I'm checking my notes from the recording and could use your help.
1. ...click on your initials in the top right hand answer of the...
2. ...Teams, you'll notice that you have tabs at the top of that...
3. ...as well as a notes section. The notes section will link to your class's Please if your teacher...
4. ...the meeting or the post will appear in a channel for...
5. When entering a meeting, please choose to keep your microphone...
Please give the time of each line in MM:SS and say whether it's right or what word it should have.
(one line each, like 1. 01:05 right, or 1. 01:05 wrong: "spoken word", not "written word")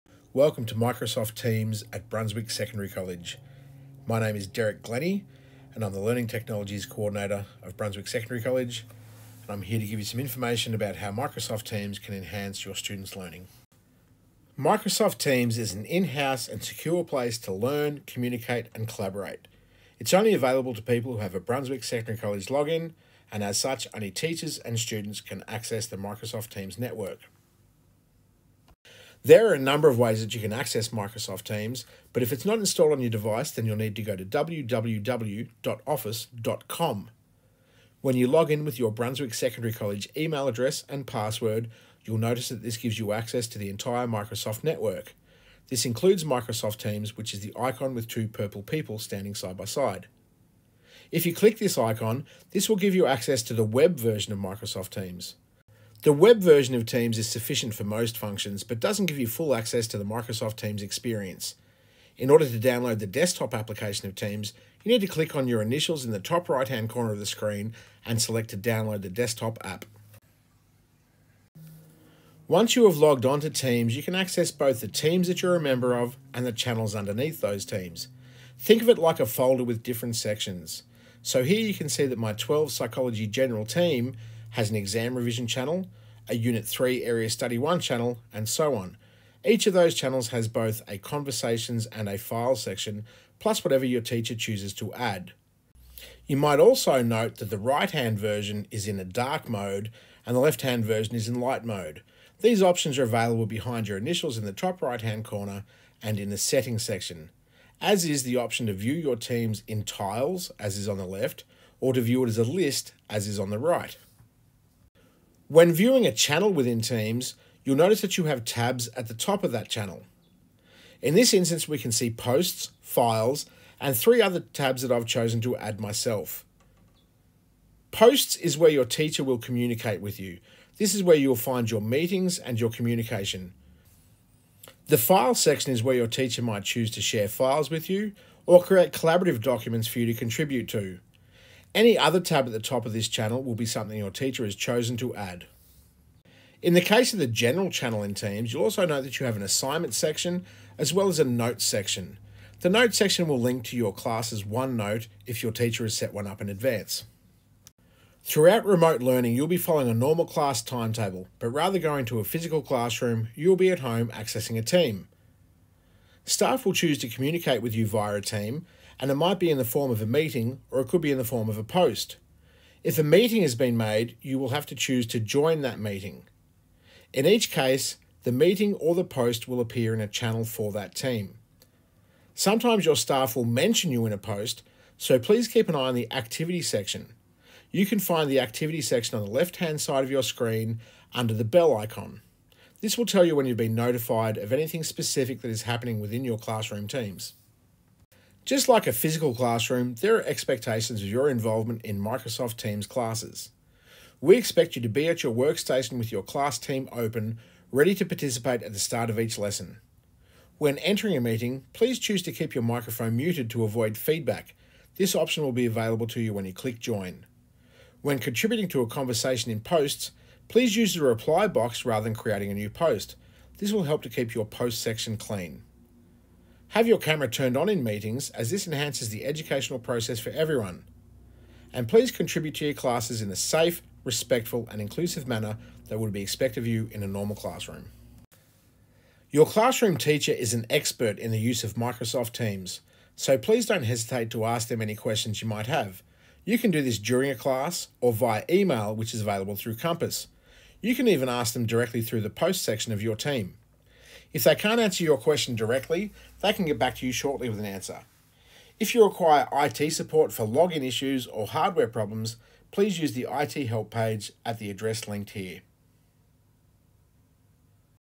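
1. 01:05 wrong: "corner", not "answer"
2. 01:56 right
3. 02:30 wrong: "OneNote", not "Please"
4. 02:58 right
5. 03:30 right.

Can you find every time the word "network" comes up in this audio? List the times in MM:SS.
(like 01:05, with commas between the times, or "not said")
00:26, 00:44.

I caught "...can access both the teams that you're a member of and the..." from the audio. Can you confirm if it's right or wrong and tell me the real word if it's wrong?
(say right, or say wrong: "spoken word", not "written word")
right.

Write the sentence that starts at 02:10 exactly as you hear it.
This is where you'll find your meetings and your communication.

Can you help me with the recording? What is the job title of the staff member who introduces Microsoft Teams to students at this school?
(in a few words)
Learning Technologies Coordinator.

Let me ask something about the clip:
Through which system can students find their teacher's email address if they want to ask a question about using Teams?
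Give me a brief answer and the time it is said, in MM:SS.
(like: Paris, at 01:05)
Compass, at 04:09.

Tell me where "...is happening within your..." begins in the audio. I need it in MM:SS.
03:15.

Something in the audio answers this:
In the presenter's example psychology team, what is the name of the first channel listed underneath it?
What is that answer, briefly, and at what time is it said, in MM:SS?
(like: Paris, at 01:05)
exam revision, at 01:24.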